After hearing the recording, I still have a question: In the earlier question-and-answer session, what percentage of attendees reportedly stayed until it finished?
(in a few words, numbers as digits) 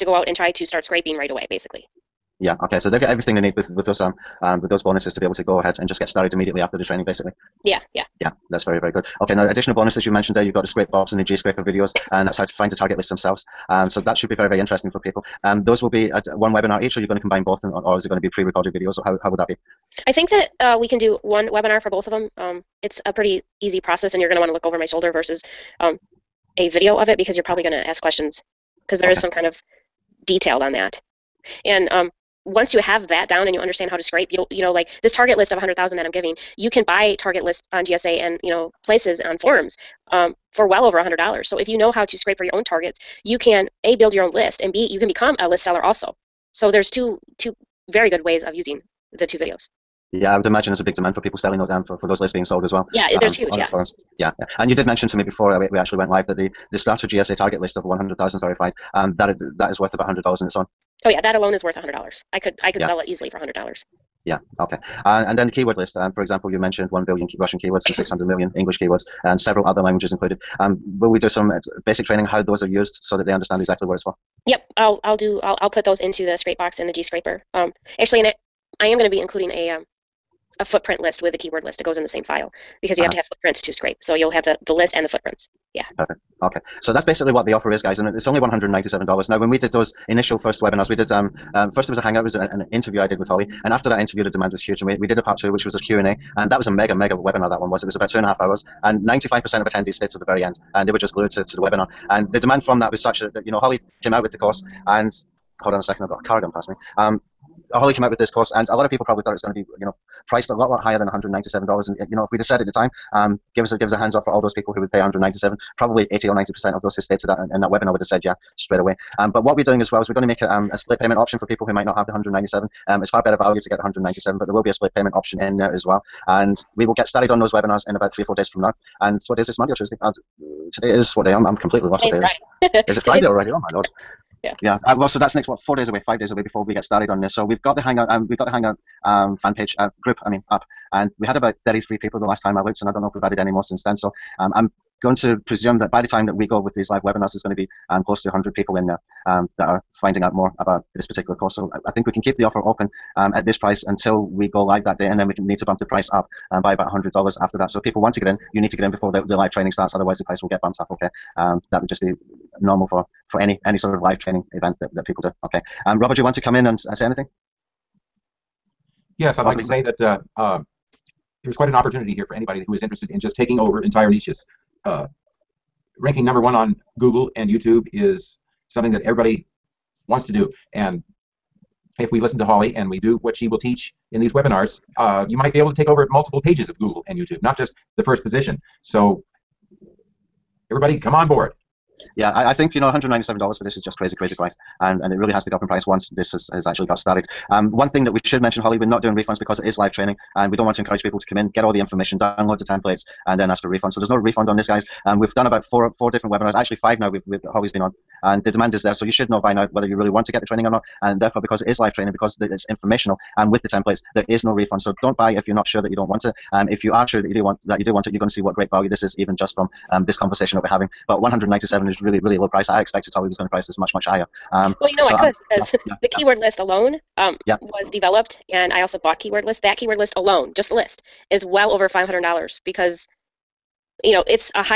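95%.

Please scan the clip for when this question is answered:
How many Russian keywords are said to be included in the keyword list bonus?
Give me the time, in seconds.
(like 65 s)
66 s.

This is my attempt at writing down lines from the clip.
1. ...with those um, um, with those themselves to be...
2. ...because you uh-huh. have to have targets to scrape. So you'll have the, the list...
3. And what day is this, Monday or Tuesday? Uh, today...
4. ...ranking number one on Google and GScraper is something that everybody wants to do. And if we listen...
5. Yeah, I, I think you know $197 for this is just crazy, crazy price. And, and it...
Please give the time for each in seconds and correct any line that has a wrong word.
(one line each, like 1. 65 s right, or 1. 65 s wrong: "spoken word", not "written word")
1. 3 s wrong: "bonuses", not "themselves"
2. 82 s wrong: "footprints", not "targets"
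3. 129 s right
4. 175 s wrong: "YouTube", not "GScraper"
5. 192 s right.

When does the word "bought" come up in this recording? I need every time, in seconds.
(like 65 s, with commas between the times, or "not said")
228 s.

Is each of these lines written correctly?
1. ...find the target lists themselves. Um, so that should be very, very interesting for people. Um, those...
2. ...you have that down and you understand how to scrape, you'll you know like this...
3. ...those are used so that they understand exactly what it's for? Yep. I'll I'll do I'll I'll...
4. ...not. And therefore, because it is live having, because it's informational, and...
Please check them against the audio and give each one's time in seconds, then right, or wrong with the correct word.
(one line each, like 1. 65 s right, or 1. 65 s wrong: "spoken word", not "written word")
1. 12 s right
2. 32 s right
3. 72 s right
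4. 210 s wrong: "training", not "having".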